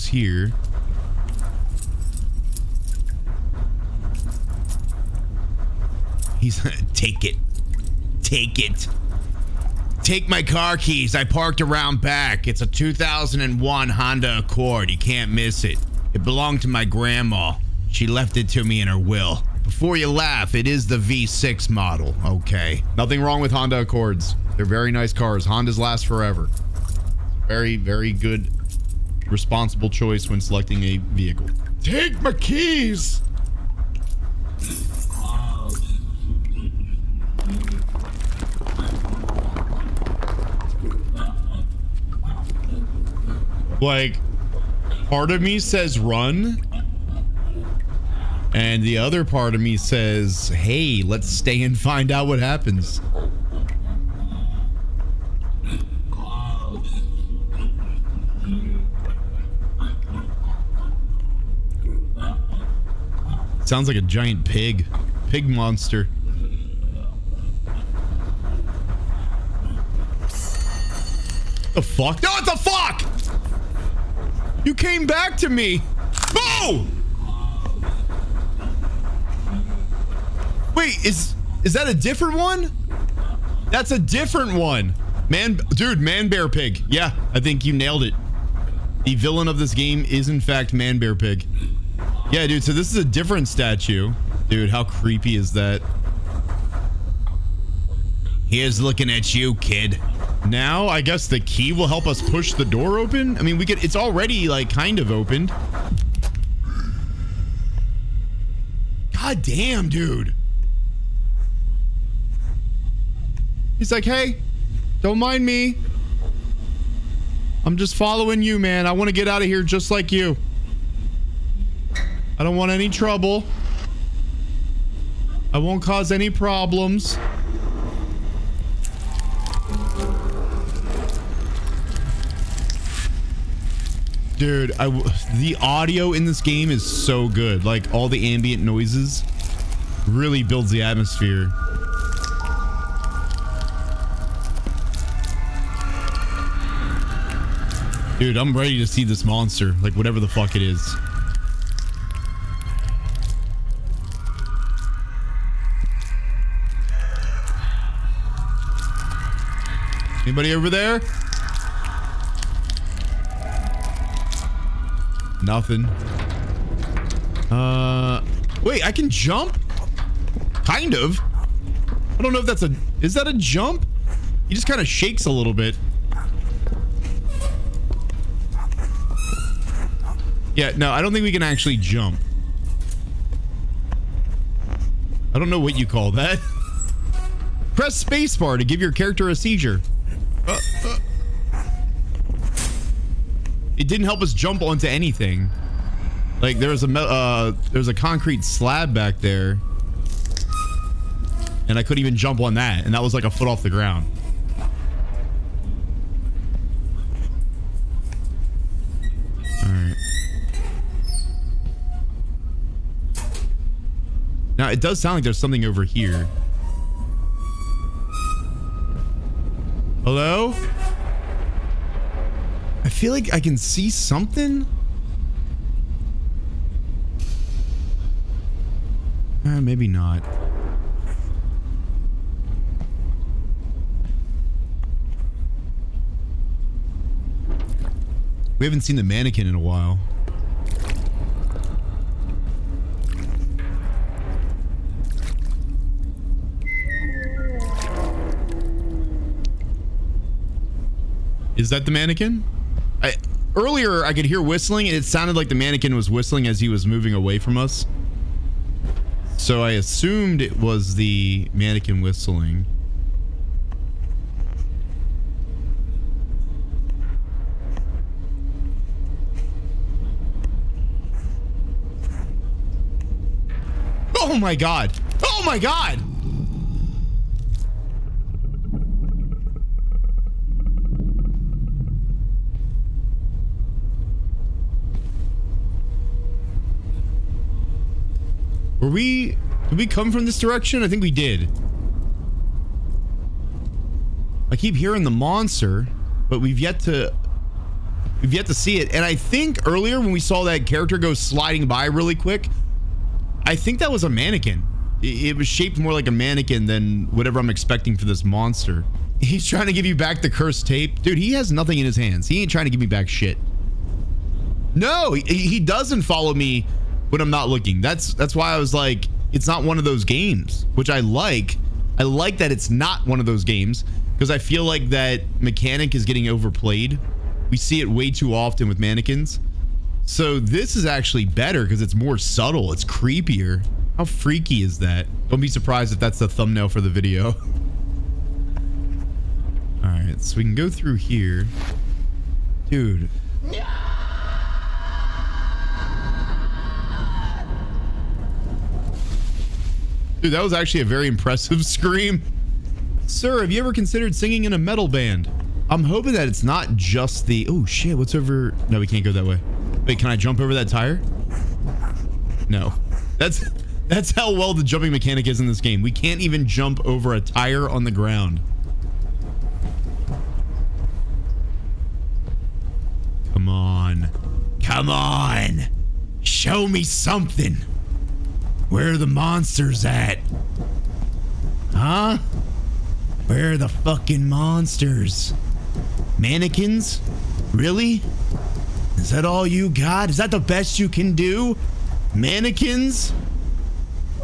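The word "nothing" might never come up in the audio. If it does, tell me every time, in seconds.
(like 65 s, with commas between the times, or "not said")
22 s, 165 s, 311 s.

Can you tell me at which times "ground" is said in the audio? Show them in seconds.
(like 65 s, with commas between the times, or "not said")
203 s, 367 s.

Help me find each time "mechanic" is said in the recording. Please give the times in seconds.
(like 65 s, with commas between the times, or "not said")
325 s, 364 s.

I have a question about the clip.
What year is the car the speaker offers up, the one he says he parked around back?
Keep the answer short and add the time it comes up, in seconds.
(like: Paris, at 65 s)
2001, at 12 s.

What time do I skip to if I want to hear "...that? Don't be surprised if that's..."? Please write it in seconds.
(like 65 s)
334 s.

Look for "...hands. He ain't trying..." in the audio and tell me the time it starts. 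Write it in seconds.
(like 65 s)
311 s.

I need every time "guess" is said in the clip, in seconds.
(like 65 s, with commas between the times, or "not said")
101 s.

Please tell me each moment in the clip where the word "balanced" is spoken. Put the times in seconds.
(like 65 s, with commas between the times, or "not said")
not said.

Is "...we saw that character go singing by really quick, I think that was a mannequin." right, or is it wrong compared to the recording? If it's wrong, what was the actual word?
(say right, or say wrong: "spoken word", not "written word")
wrong: "sliding", not "singing".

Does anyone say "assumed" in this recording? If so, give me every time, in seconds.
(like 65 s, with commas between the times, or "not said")
259 s.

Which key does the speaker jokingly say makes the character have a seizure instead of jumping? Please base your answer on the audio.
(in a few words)
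Spacebar.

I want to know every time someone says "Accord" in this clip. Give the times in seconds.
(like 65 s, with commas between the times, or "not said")
14 s, 23 s.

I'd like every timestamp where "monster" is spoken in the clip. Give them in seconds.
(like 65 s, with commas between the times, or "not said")
65 s, 149 s, 295 s, 308 s, 379 s, 384 s.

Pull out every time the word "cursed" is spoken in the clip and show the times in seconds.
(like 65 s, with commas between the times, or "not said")
310 s.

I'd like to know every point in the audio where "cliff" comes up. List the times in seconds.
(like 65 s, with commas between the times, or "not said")
not said.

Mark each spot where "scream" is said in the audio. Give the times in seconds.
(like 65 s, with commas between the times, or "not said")
351 s.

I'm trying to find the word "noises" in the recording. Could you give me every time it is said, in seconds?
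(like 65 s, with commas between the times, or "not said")
138 s.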